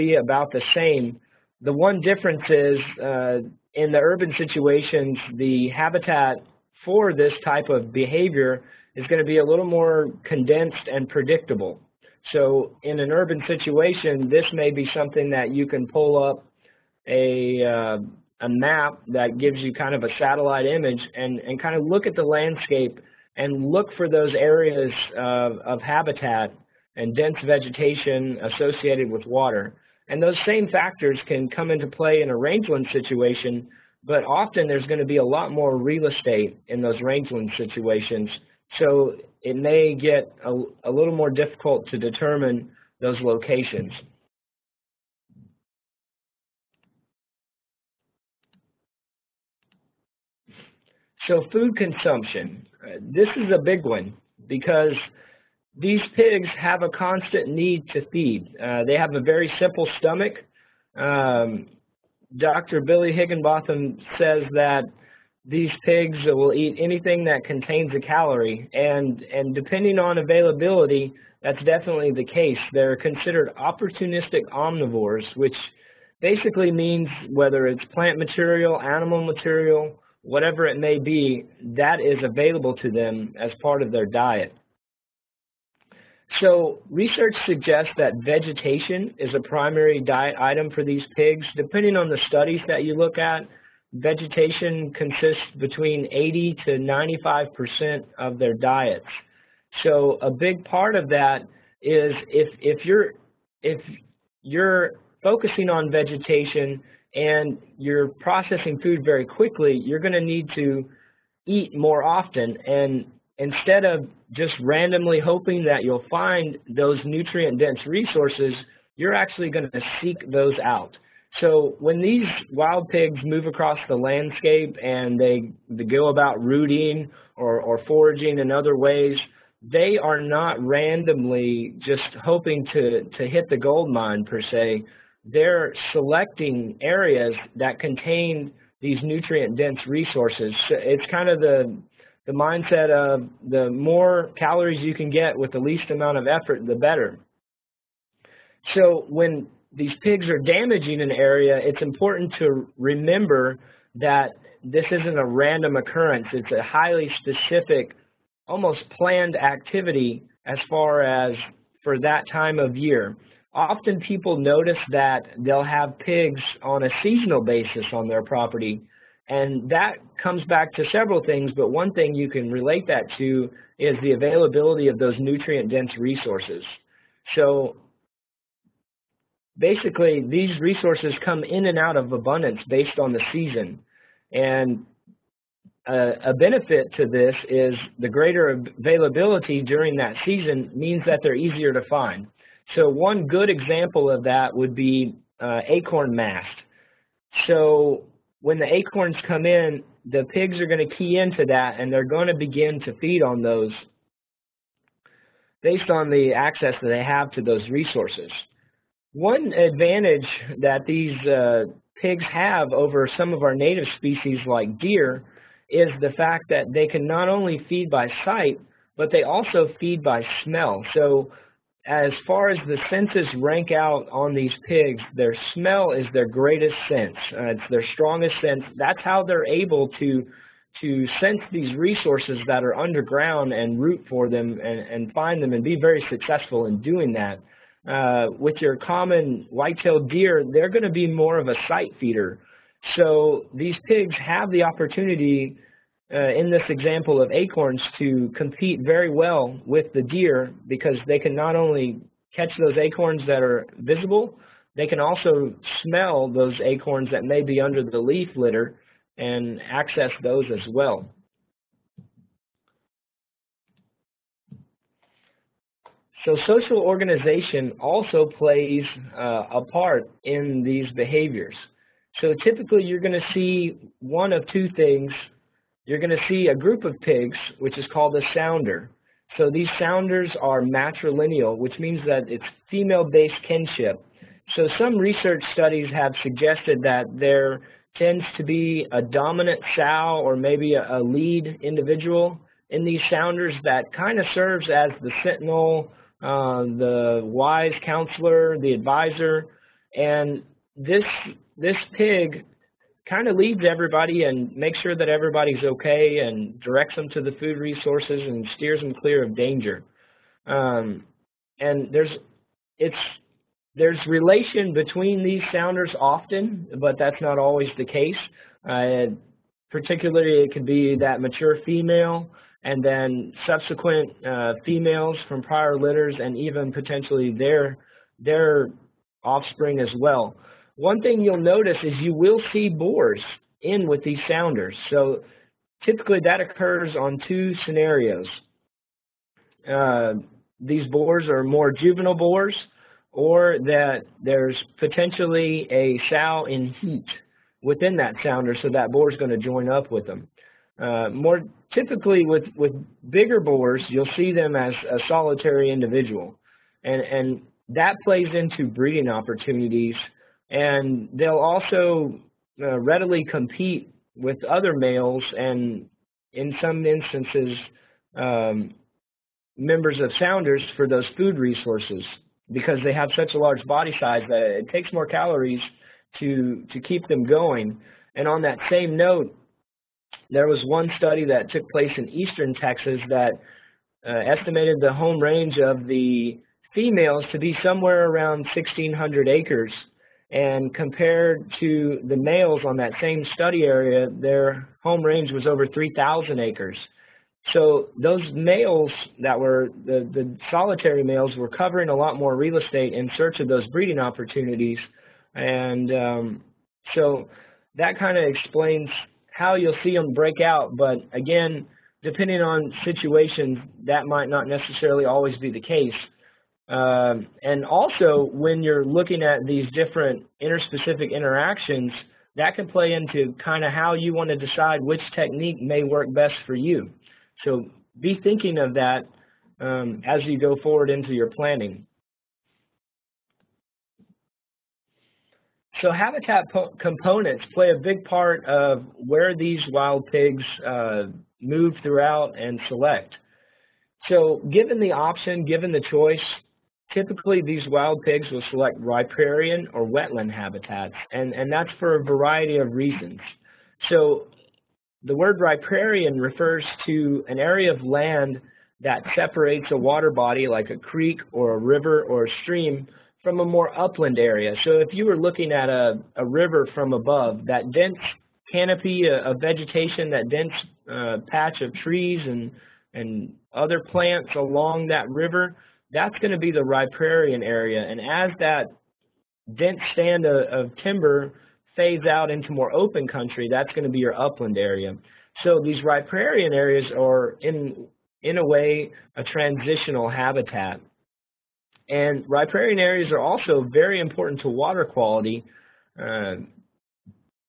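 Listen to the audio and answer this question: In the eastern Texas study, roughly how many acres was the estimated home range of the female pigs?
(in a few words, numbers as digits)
1,600 acres.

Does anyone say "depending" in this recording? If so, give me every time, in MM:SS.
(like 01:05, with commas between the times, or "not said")
01:09, 01:31, 06:52.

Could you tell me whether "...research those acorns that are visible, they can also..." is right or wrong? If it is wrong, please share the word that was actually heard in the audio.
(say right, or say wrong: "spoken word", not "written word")
wrong: "catch", not "research".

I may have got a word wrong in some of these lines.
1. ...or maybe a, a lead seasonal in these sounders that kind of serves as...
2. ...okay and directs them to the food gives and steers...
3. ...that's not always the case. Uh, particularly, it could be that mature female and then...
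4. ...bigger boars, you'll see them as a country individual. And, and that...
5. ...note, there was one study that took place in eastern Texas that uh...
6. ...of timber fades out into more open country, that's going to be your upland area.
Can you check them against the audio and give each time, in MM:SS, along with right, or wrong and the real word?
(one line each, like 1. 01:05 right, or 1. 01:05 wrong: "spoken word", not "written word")
1. 04:50 wrong: "individual", not "seasonal"
2. 05:05 wrong: "resources", not "gives"
3. 05:16 right
4. 05:53 wrong: "solitary", not "country"
5. 06:18 right
6. 08:00 right.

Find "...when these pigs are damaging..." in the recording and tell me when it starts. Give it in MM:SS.
02:29.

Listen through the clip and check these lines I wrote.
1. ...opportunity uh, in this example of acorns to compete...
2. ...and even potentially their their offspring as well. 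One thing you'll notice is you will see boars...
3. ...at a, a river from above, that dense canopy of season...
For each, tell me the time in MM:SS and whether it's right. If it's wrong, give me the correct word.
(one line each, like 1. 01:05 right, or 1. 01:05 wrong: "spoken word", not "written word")
1. 04:04 right
2. 05:26 right
3. 07:45 wrong: "vegetation", not "season".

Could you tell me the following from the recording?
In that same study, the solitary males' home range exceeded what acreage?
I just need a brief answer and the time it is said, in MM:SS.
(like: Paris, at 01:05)
3,000 acres, at 06:35.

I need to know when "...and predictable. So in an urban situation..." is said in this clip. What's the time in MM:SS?
00:10.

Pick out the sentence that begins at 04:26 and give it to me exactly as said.
So social organization also plays uh, a part in these behaviors.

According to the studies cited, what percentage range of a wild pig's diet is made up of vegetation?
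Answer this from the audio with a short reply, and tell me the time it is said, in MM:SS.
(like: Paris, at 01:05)
80 to 95%, at 01:36.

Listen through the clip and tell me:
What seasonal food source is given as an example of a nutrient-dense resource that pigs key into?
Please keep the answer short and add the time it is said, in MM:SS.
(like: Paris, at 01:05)
Acorn mast, at 03:15.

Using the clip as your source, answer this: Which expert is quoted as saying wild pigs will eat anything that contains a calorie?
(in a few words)
Dr. Billy Higginbotham.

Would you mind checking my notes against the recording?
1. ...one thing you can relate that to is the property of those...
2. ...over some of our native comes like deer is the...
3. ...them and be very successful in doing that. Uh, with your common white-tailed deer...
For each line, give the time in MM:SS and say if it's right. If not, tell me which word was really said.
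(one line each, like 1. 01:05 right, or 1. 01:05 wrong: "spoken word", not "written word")
1. 02:51 wrong: "availability", not "property"
2. 03:32 wrong: "species", not "comes"
3. 03:55 right.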